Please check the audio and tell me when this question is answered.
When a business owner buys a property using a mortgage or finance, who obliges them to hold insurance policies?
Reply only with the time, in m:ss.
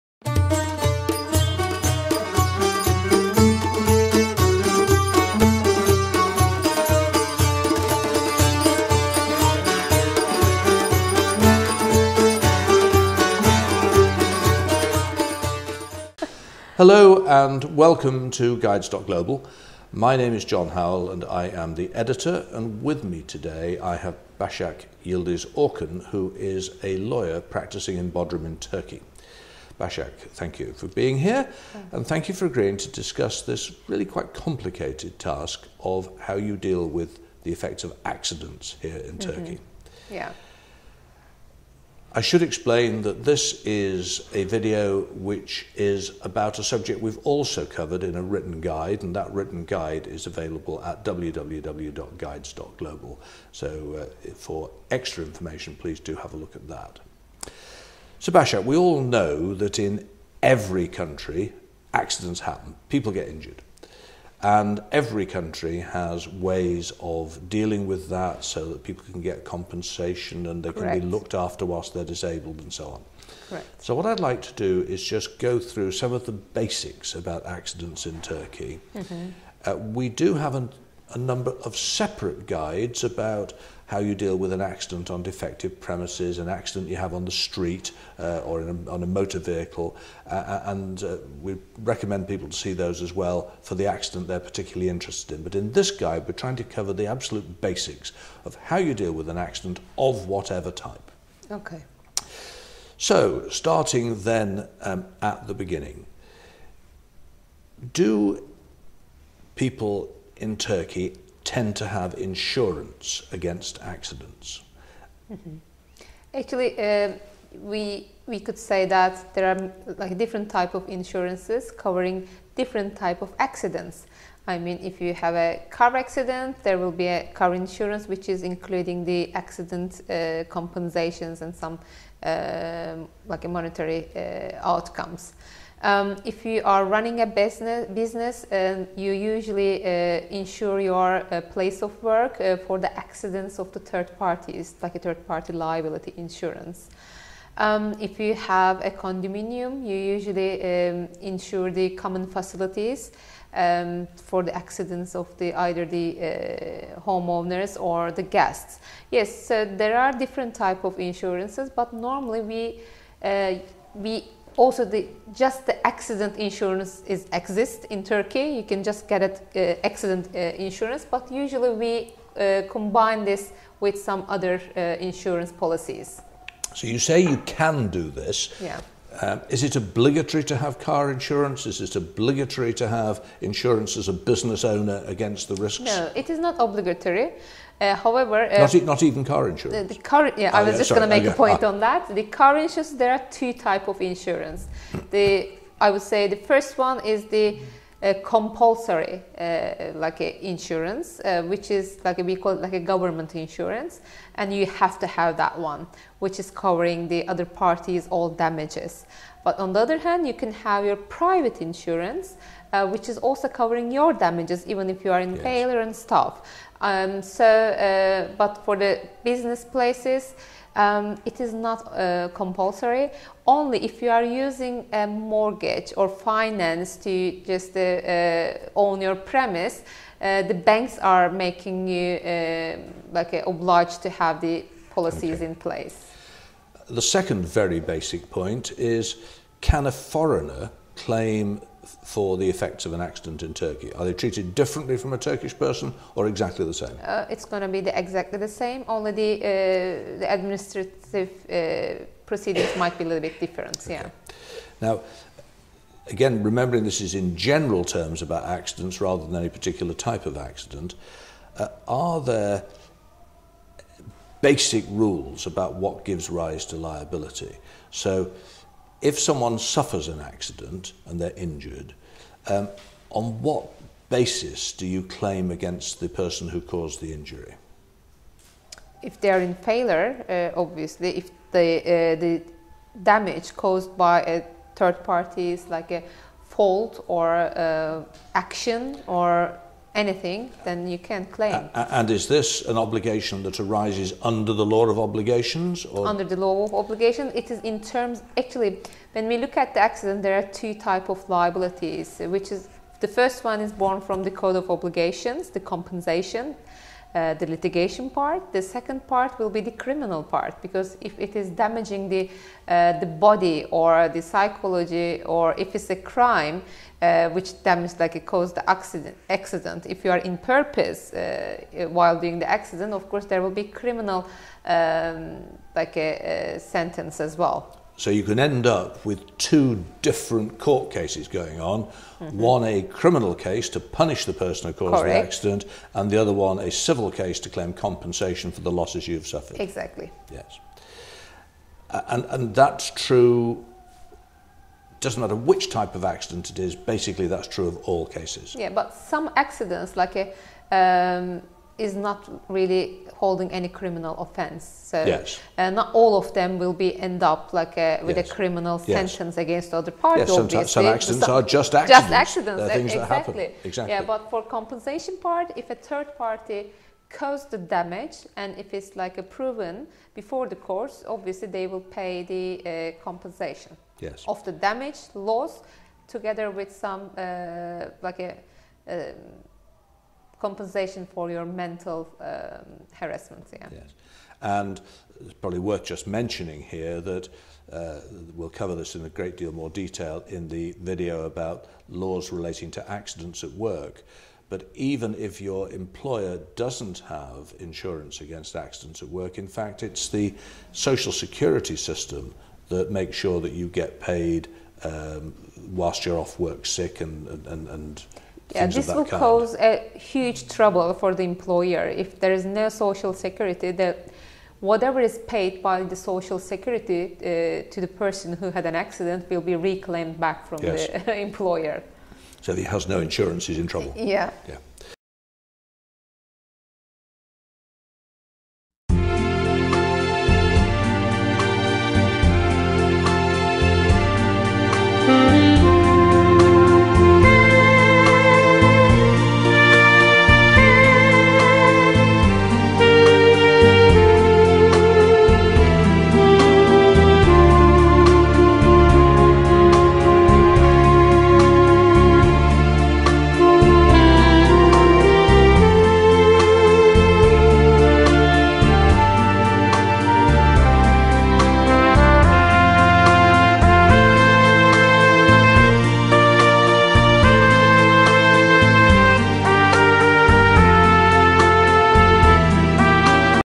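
3:50.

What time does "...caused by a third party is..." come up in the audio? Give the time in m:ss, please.
4:43.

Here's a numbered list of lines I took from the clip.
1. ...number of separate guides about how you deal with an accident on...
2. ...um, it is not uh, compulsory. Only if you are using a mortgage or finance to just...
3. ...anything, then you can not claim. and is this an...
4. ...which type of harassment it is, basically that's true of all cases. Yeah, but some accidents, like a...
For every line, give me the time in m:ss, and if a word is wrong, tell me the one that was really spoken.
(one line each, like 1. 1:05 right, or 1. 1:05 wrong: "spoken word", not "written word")
1. 1:21 right
2. 3:40 right
3. 4:49 right
4. 5:45 wrong: "accident", not "harassment".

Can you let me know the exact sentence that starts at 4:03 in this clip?
Are they treated differently from a Turkish person or exactly the same?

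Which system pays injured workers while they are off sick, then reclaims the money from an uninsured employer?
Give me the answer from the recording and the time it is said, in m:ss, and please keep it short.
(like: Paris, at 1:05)
social security system, at 6:40.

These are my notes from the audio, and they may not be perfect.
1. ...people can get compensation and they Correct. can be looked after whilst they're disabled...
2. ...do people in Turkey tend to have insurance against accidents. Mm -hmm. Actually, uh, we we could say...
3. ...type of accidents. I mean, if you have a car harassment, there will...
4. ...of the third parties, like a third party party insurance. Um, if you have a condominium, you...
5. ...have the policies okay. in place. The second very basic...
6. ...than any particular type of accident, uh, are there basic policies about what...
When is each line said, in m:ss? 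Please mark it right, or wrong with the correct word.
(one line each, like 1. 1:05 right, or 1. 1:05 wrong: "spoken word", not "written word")
1. 1:08 right
2. 1:47 right
3. 2:02 wrong: "accident", not "harassment"
4. 2:23 wrong: "liability", not "party"
5. 3:54 right
6. 4:19 wrong: "rules", not "policies".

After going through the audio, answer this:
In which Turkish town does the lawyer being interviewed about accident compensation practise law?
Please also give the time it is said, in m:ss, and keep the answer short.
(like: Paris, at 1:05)
Bodrum, at 0:28.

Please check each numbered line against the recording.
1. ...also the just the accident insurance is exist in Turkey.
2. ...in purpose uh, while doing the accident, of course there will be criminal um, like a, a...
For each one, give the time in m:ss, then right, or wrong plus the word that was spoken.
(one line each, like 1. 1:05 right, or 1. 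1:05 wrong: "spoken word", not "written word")
1. 2:44 right
2. 5:20 right.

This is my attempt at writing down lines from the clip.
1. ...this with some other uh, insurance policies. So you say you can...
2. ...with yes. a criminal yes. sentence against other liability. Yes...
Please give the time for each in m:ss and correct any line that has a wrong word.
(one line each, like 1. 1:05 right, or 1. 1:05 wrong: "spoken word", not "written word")
1. 2:53 right
2. 5:58 wrong: "party", not "liability".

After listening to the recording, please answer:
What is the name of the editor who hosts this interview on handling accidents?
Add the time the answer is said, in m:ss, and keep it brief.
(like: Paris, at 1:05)
John Howell, at 0:20.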